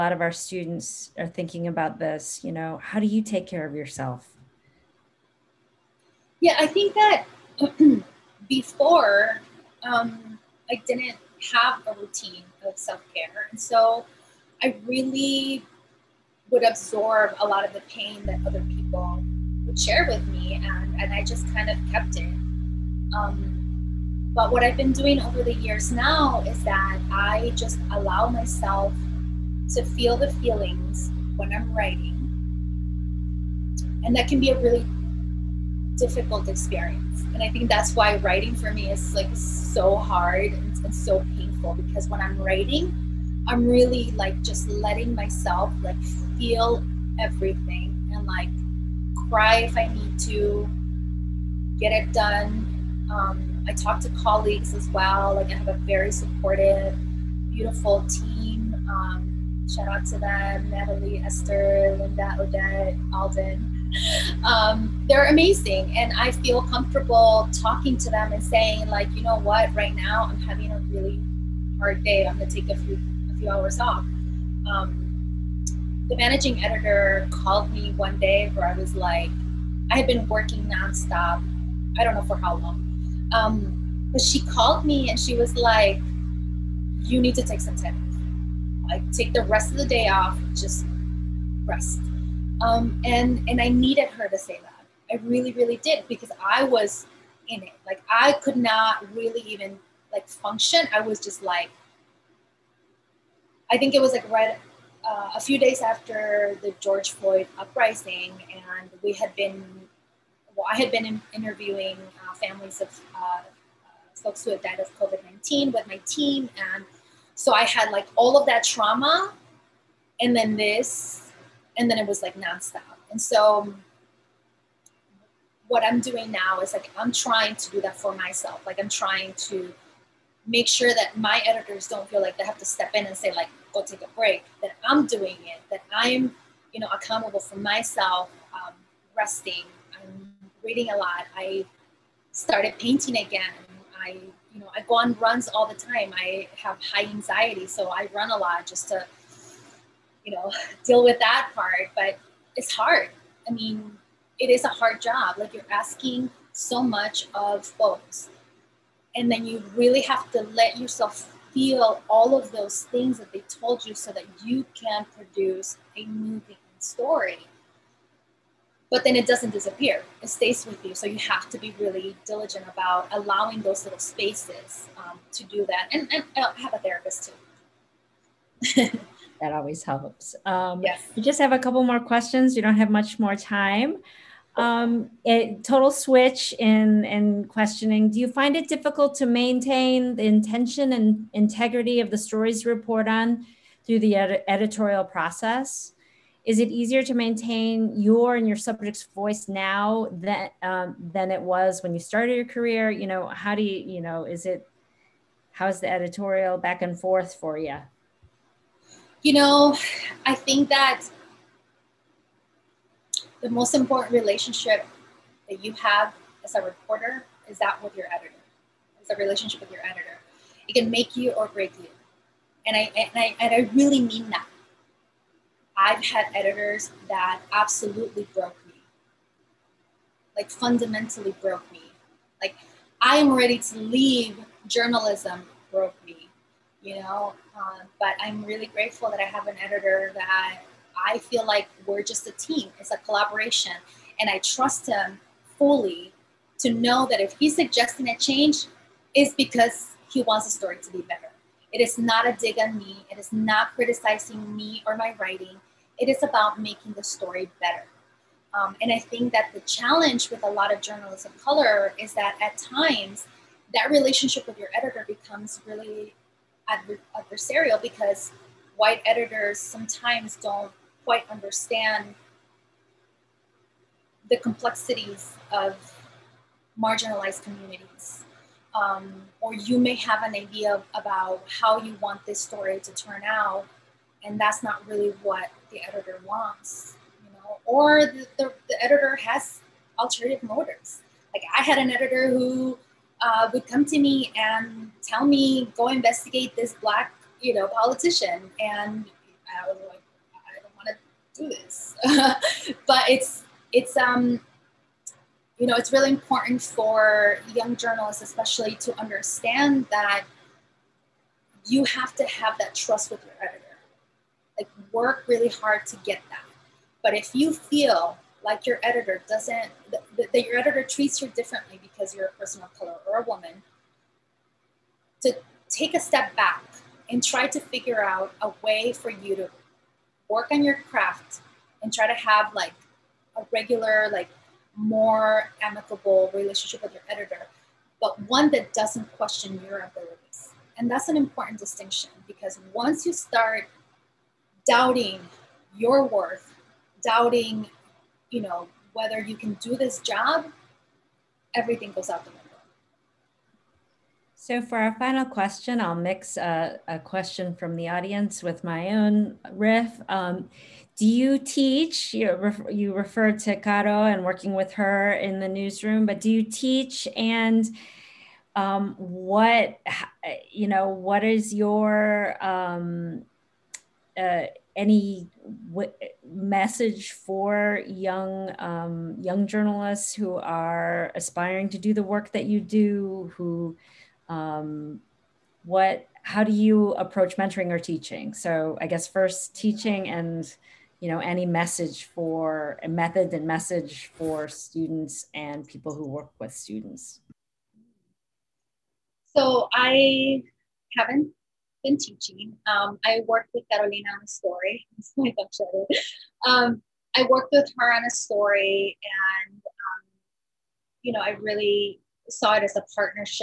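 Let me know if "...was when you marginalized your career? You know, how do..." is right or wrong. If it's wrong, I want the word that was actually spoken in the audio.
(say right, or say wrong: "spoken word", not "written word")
wrong: "started", not "marginalized".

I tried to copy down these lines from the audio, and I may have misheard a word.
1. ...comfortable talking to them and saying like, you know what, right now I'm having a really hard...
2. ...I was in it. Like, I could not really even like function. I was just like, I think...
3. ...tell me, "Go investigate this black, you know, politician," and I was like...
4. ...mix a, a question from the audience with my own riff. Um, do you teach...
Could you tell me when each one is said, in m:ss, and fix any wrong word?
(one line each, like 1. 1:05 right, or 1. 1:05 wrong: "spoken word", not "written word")
1. 1:06 right
2. 1:36 right
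3. 4:55 right
4. 5:55 right.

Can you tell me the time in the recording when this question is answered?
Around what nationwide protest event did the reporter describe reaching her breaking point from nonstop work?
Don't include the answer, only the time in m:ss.
1:46.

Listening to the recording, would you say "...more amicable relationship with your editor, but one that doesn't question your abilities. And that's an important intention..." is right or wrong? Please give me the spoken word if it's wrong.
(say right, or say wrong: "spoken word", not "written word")
wrong: "distinction", not "intention".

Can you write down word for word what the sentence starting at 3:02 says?
You don't have much more time um, it, total switch in, in questioning.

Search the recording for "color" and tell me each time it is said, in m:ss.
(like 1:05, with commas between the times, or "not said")
4:21, 5:22.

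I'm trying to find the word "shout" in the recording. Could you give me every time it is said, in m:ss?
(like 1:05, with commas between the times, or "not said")
0:59.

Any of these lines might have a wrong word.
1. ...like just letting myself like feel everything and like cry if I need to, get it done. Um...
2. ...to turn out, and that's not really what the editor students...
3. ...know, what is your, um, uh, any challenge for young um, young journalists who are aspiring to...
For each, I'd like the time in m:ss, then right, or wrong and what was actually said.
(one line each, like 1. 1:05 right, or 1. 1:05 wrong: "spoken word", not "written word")
1. 0:44 right
2. 4:42 wrong: "wants", not "students"
3. 6:10 wrong: "message", not "challenge".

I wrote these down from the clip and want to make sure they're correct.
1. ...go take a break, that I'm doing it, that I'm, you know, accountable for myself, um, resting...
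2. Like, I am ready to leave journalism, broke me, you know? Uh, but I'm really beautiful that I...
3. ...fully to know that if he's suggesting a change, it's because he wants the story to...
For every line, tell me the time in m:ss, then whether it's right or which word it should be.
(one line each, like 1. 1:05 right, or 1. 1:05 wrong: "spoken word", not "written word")
1. 2:13 right
2. 3:52 wrong: "grateful", not "beautiful"
3. 4:05 right.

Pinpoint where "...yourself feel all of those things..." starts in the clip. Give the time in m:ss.
2:40.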